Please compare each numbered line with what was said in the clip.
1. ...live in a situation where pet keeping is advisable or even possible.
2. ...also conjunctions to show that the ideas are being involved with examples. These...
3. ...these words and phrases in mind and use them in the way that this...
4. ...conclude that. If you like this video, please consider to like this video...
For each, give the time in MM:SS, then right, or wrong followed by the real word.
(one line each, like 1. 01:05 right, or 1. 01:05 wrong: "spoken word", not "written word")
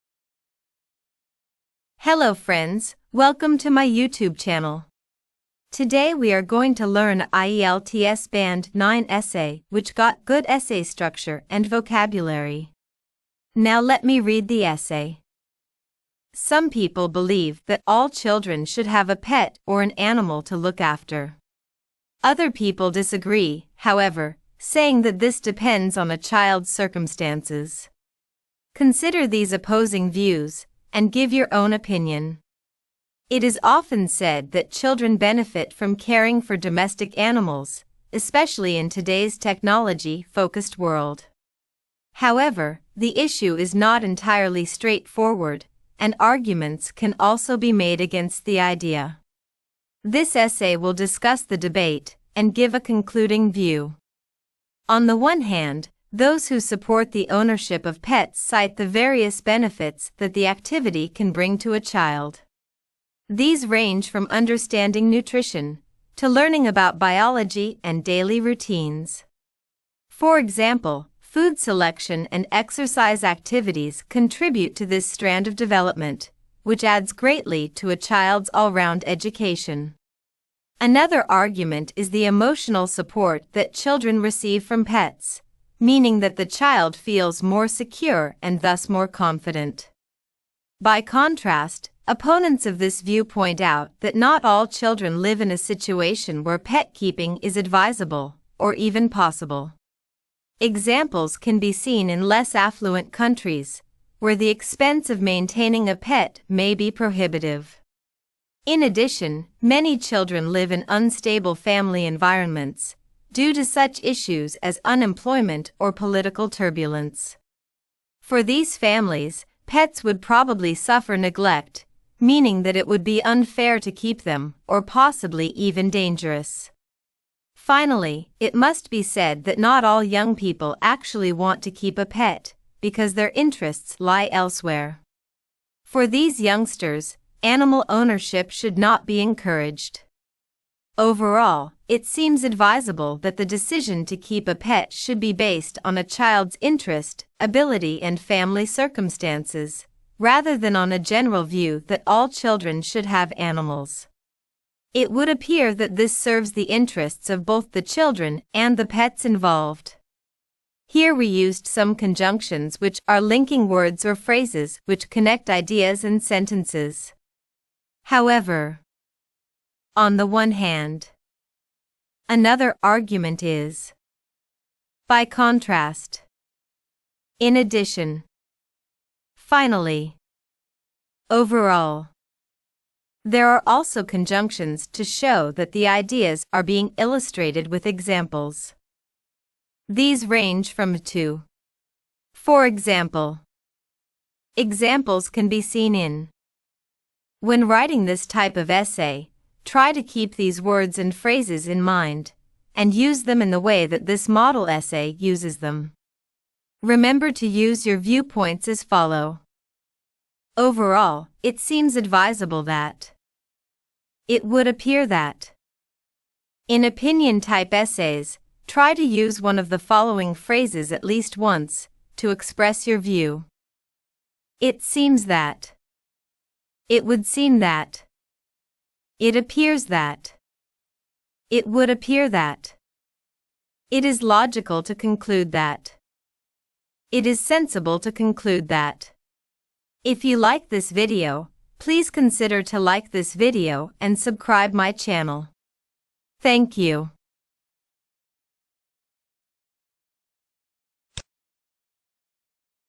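1. 01:35 right
2. 03:03 wrong: "illustrated", not "involved"
3. 03:20 right
4. 03:58 right.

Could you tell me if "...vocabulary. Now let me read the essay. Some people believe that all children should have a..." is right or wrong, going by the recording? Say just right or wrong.
right.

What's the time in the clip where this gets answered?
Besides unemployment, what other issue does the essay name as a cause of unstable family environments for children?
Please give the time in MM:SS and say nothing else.
01:55.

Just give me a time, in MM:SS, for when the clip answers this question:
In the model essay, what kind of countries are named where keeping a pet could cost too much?
01:42.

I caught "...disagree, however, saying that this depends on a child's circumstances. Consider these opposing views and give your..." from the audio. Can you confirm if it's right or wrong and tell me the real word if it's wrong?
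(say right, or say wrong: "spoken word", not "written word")
right.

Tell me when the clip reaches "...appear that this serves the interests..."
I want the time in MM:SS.
02:35.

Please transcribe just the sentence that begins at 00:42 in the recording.
However, the issue is not entirely straightforward, and arguments can also be made against the idea.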